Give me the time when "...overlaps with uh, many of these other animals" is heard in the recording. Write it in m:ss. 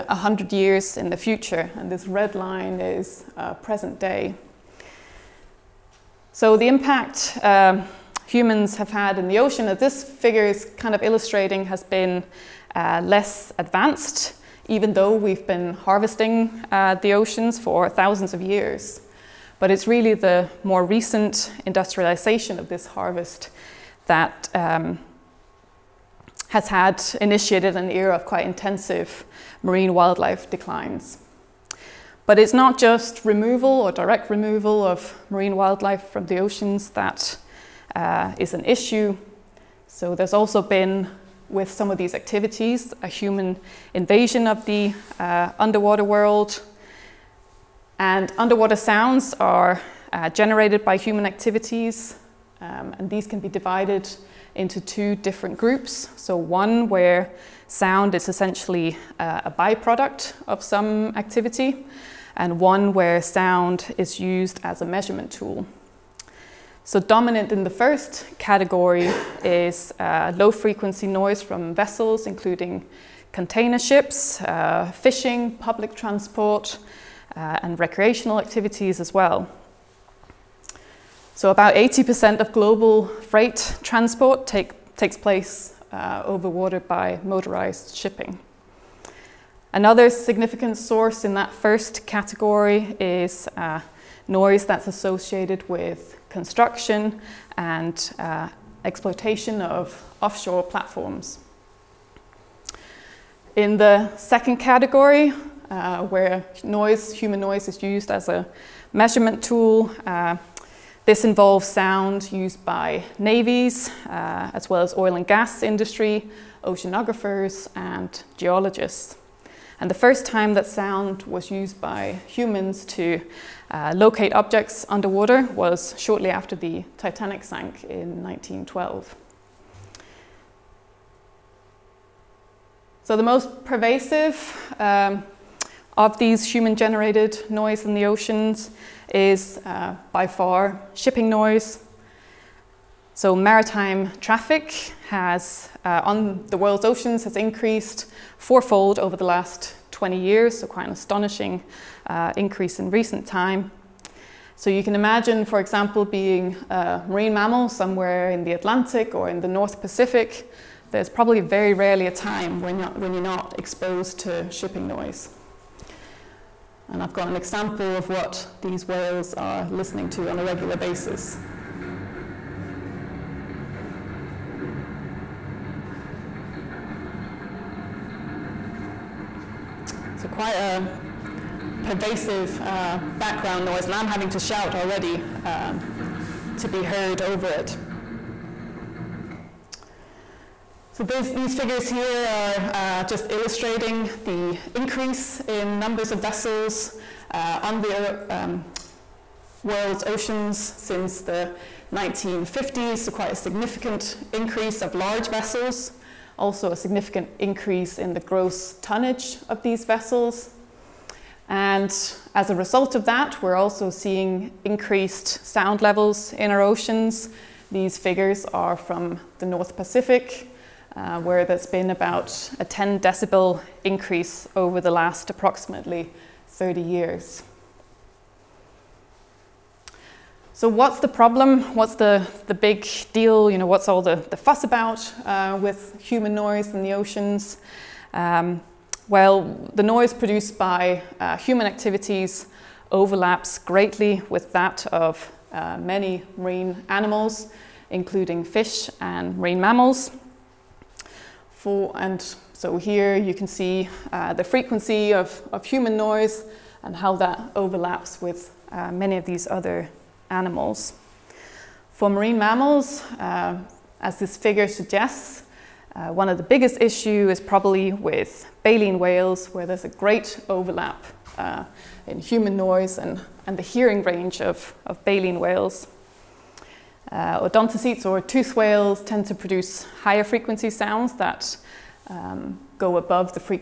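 4:17.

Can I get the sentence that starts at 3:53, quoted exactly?
You know, what's all the, the fuss about uh, with human noise in the oceans?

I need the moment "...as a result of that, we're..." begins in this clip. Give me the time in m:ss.
3:32.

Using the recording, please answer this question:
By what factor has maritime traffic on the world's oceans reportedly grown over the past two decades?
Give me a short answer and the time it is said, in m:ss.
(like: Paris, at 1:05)
Fourfold, at 2:28.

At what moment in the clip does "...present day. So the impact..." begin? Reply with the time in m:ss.
0:03.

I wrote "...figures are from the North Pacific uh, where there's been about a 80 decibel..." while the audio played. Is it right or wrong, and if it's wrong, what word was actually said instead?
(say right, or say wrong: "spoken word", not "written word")
wrong: "10", not "80".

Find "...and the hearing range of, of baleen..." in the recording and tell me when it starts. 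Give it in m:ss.
4:33.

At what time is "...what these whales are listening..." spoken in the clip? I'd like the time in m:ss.
2:48.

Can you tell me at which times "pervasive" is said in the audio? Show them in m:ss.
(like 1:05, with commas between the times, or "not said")
2:13, 3:01.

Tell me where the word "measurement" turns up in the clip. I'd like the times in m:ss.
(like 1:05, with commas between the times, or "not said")
1:04, 1:48.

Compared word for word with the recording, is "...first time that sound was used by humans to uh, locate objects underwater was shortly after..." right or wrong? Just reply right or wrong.
right.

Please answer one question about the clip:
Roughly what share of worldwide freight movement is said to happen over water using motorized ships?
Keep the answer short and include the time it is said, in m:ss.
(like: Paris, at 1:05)
80%, at 1:21.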